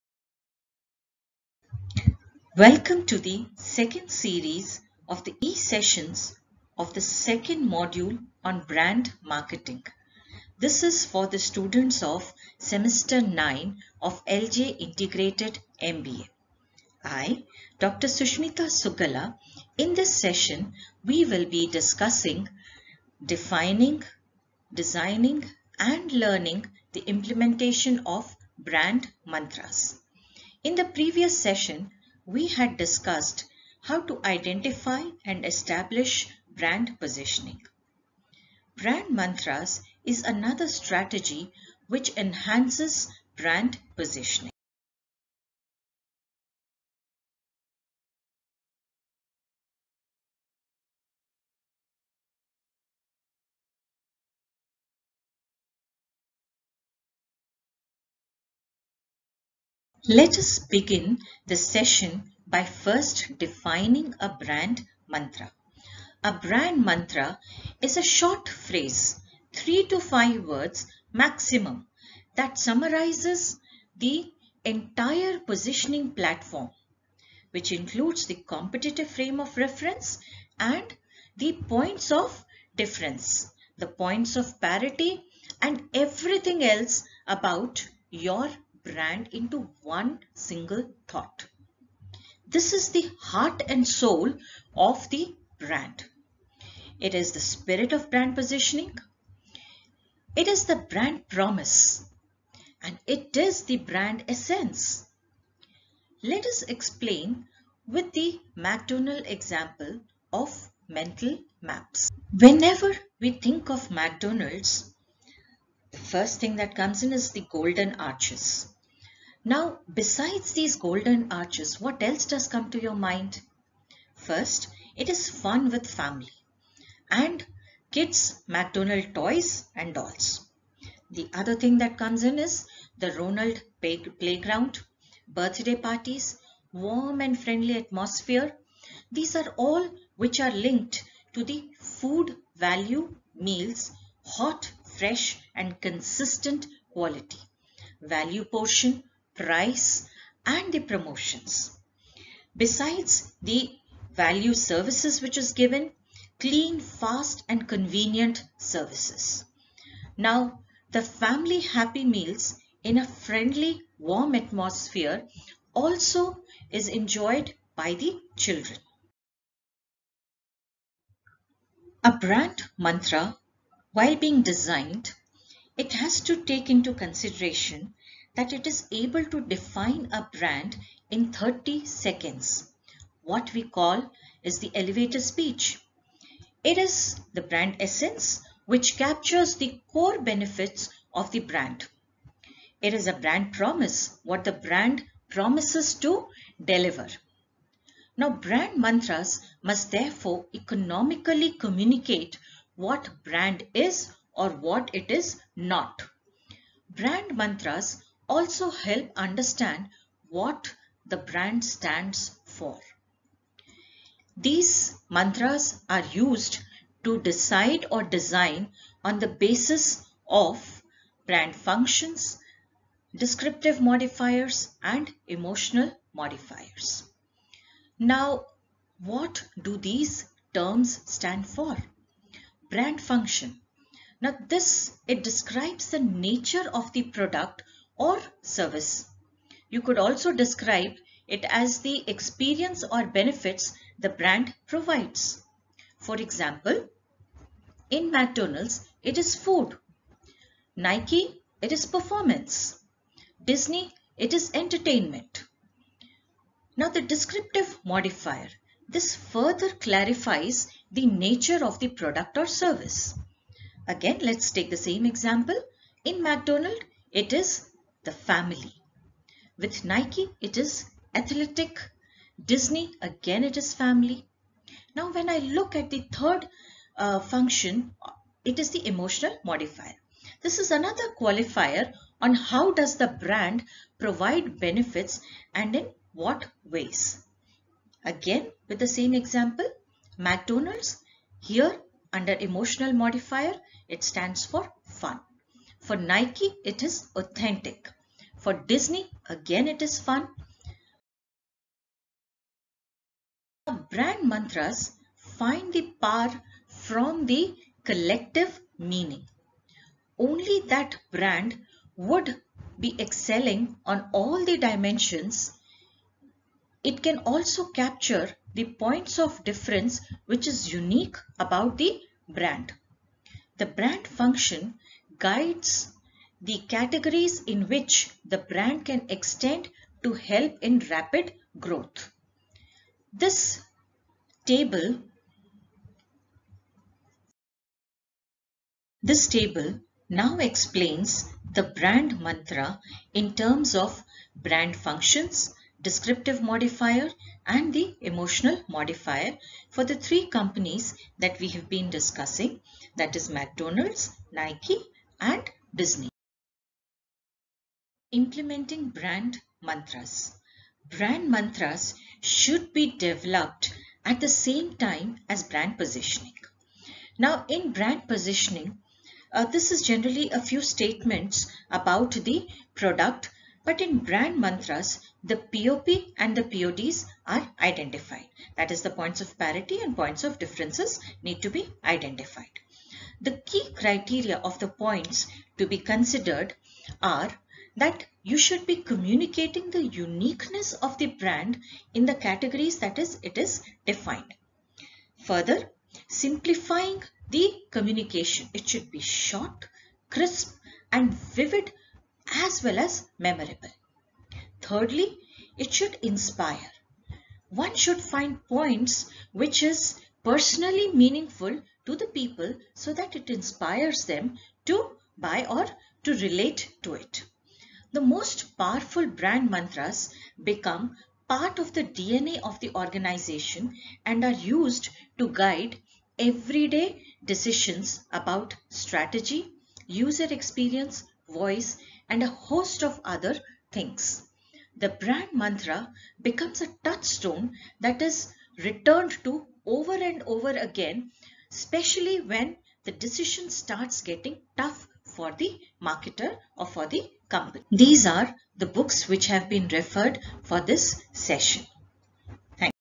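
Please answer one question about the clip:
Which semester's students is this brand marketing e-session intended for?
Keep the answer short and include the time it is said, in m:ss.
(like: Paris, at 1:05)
Semester 9, at 0:12.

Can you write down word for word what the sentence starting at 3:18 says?
Now, brand mantras must therefore economically communicate what brand is or what it is not.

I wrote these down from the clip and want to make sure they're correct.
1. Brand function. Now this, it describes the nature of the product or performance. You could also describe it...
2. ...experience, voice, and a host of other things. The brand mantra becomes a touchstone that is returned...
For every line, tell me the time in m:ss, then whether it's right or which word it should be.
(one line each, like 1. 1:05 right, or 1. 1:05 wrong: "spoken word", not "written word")
1. 3:52 wrong: "service", not "performance"
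2. 7:10 right.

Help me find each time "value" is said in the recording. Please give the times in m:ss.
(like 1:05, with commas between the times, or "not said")
2:22, 2:27, 2:34.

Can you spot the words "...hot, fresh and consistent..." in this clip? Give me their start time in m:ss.
2:24.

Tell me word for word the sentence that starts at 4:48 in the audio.
Again, with the same example, McDonald's, here under emotional modifier, it stands for fun.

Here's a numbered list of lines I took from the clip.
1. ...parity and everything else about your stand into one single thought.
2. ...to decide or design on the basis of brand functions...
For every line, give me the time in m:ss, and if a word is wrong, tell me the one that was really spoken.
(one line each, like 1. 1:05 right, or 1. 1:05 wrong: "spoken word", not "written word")
1. 1:24 wrong: "brand", not "stand"
2. 3:37 right.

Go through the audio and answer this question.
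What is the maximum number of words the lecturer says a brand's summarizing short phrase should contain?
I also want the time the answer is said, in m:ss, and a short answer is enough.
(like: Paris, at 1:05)
5, at 1:09.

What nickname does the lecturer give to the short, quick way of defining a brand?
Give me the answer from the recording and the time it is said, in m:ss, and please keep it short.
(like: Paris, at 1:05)
The elevator speech, at 3:04.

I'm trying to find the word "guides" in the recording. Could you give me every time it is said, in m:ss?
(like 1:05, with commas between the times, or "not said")
5:25, 7:05.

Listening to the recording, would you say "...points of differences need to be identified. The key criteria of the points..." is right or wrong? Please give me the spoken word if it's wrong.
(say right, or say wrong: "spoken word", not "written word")
right.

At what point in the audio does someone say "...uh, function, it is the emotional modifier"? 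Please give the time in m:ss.
4:36.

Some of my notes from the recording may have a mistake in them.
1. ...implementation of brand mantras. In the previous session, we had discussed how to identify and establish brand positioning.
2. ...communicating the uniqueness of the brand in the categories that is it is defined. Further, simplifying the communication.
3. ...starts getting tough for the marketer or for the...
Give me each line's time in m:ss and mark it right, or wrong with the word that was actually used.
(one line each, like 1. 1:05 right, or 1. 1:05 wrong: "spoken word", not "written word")
1. 0:27 right
2. 6:28 right
3. 7:23 right.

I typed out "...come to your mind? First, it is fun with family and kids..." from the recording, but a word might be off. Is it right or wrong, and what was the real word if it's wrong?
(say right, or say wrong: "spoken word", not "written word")
right.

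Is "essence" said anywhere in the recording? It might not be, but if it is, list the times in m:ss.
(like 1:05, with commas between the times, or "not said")
1:44, 3:07.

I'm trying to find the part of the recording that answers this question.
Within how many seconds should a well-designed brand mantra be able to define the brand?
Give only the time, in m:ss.
3:01.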